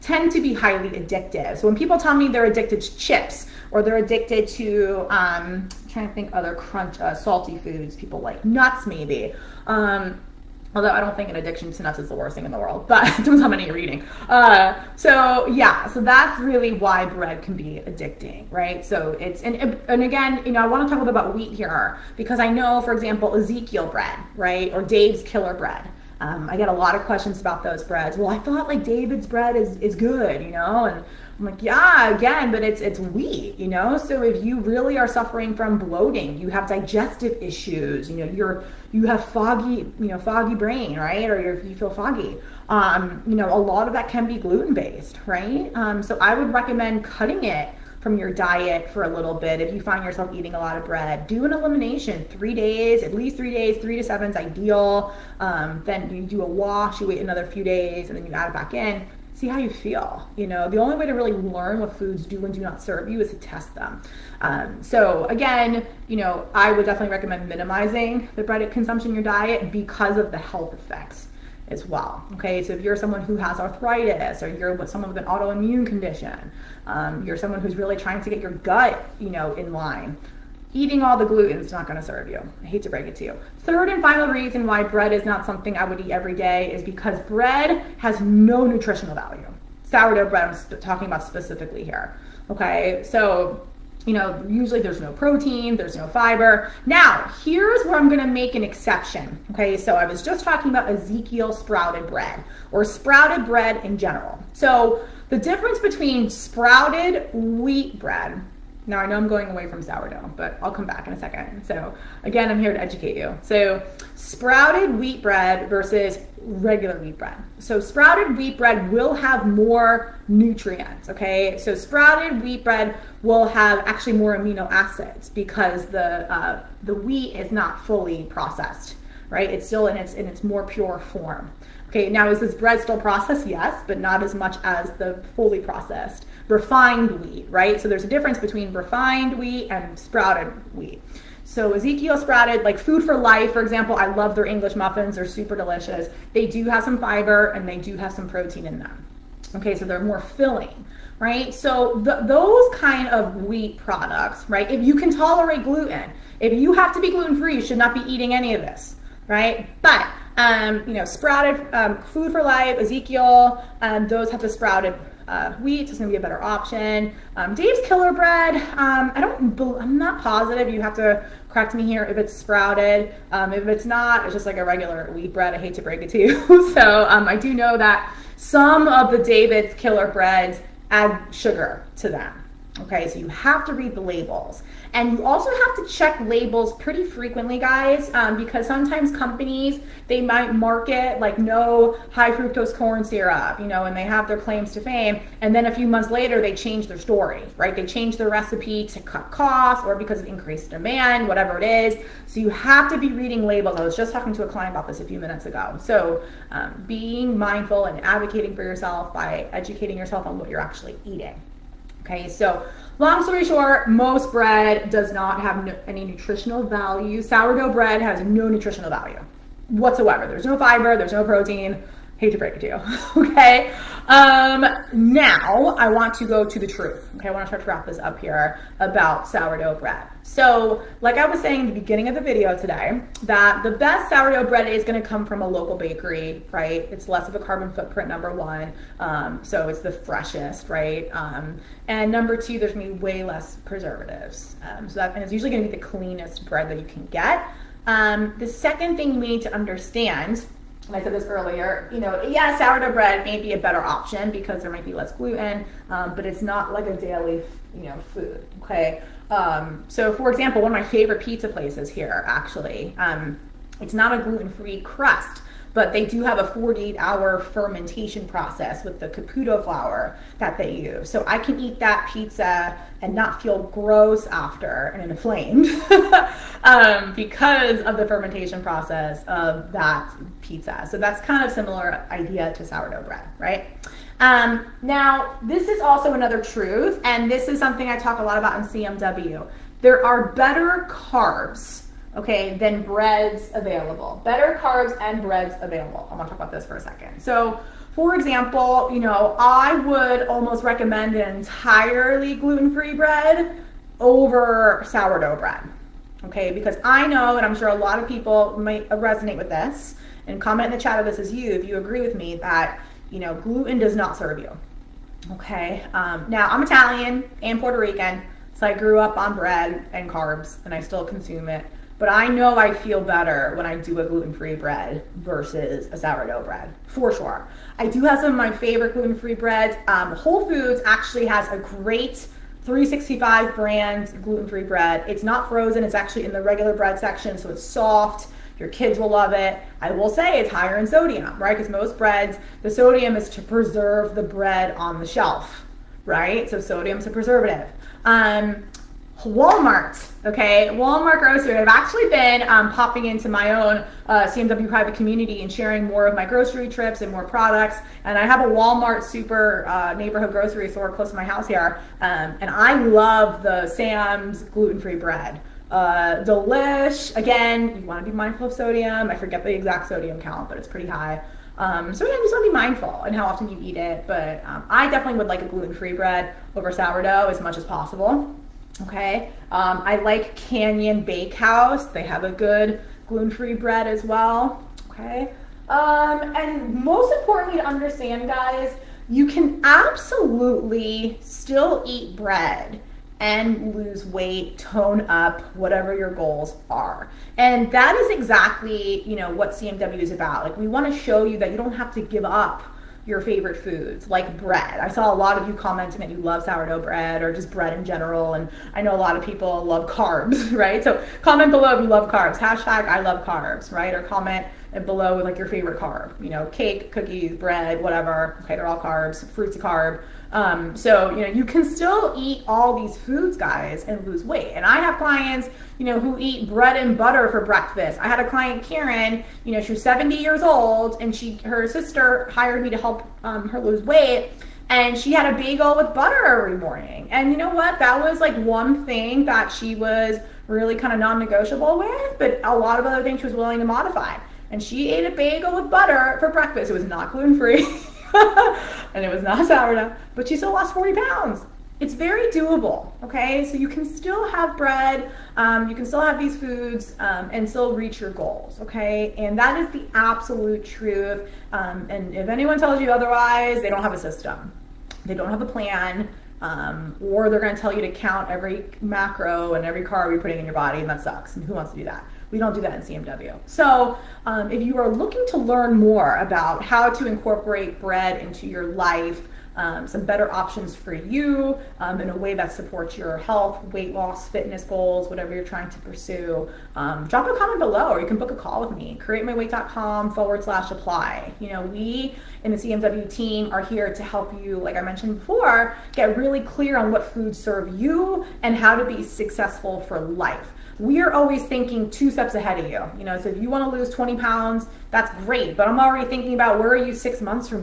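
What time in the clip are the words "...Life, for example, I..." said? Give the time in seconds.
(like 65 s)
143 s.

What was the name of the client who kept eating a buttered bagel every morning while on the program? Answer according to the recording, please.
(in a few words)
Karen.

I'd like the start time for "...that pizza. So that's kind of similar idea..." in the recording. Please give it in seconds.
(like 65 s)
279 s.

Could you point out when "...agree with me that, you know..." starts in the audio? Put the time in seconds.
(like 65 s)
311 s.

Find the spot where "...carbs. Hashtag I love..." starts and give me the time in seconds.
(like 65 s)
412 s.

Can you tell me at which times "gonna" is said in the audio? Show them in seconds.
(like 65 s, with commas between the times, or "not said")
98 s, 467 s.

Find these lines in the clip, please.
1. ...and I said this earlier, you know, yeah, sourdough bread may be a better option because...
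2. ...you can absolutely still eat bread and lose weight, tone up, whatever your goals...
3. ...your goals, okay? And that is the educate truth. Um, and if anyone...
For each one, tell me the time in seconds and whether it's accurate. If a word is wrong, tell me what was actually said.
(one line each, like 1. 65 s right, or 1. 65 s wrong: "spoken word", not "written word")
1. 250 s right
2. 389 s right
3. 458 s wrong: "absolute", not "educate".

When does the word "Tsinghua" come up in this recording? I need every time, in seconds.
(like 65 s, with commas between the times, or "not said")
not said.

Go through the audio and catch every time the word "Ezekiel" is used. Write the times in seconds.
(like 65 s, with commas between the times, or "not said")
23 s, 100 s, 141 s, 162 s.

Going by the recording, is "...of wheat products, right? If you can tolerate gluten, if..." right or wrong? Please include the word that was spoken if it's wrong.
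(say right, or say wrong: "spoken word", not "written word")
right.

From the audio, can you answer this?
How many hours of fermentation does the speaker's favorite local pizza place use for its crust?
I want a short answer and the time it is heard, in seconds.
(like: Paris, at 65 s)
48, at 266 s.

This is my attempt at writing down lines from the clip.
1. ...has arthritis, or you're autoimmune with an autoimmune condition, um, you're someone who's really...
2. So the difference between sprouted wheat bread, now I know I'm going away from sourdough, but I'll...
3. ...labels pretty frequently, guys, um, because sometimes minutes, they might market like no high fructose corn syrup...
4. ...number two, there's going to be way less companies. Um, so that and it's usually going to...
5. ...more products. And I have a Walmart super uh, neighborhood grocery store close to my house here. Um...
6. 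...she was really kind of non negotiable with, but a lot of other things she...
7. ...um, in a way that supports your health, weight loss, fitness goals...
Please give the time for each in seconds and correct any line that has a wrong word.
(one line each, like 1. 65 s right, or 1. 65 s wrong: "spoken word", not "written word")
1. 73 s wrong: "someone", not "autoimmune"
2. 104 s right
3. 186 s wrong: "companies", not "minutes"
4. 242 s wrong: "preservatives", not "companies"
5. 357 s right
6. 439 s right
7. 481 s right.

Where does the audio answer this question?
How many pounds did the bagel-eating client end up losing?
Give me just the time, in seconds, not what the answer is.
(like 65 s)
450 s.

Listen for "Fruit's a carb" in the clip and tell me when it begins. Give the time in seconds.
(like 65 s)
419 s.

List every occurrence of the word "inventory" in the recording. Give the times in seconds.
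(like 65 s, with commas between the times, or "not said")
not said.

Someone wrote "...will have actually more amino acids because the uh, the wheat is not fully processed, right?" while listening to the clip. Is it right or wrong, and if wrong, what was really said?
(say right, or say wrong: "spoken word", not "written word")
right.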